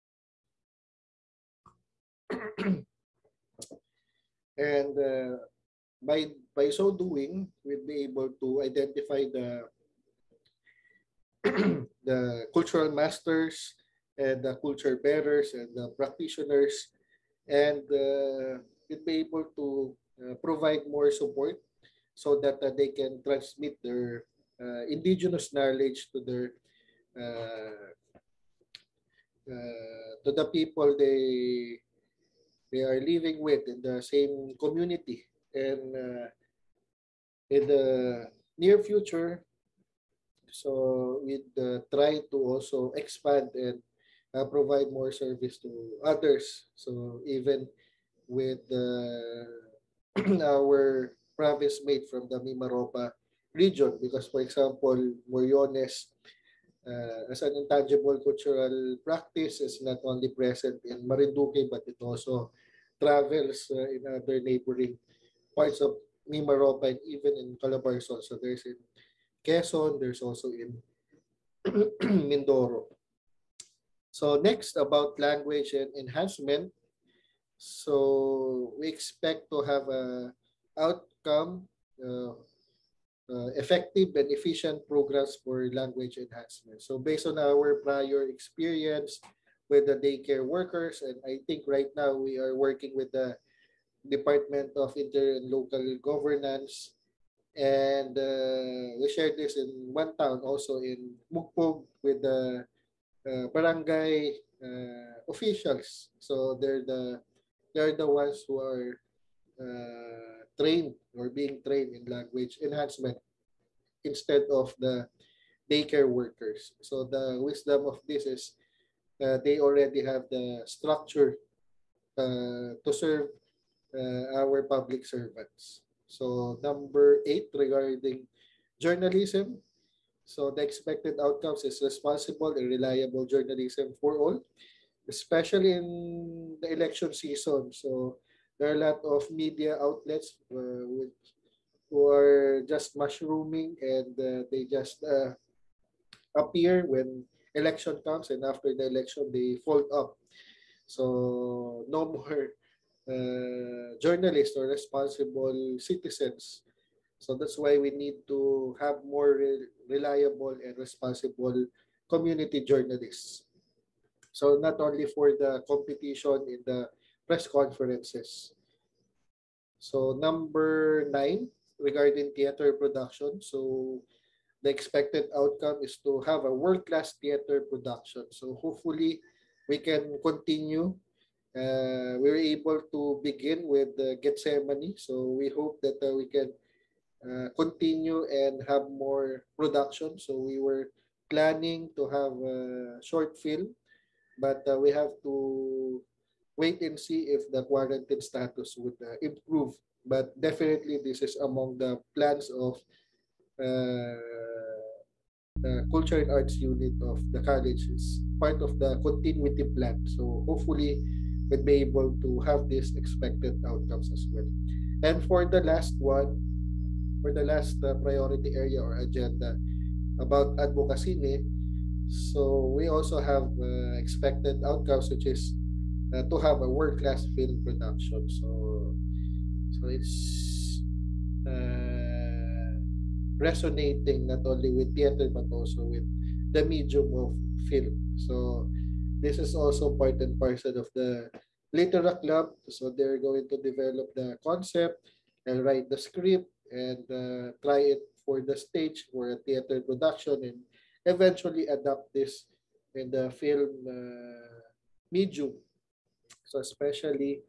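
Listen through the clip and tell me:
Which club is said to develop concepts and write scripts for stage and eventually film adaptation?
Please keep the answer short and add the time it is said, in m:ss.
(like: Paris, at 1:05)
Litera Club, at 4:01.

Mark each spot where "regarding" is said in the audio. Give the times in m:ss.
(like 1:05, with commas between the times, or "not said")
2:07, 2:51.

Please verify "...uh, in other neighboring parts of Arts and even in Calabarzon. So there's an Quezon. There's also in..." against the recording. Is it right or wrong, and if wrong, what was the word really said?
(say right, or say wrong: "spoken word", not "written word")
wrong: "Mimaropa", not "Arts".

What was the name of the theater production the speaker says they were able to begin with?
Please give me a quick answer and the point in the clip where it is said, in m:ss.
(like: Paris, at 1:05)
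Gethsemane, at 3:04.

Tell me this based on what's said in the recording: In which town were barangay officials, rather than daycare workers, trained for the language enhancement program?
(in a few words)
Mukpog.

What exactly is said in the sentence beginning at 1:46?
So they're the they're the ones who are uh, trained or being trained in language enhancement instead of the daycare workers.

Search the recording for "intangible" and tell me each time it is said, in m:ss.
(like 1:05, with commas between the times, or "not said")
0:57.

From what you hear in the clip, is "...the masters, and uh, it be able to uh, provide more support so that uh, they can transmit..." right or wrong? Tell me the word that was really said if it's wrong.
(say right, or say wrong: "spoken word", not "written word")
wrong: "practitioners", not "masters".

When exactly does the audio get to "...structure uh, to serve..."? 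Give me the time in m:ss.
2:00.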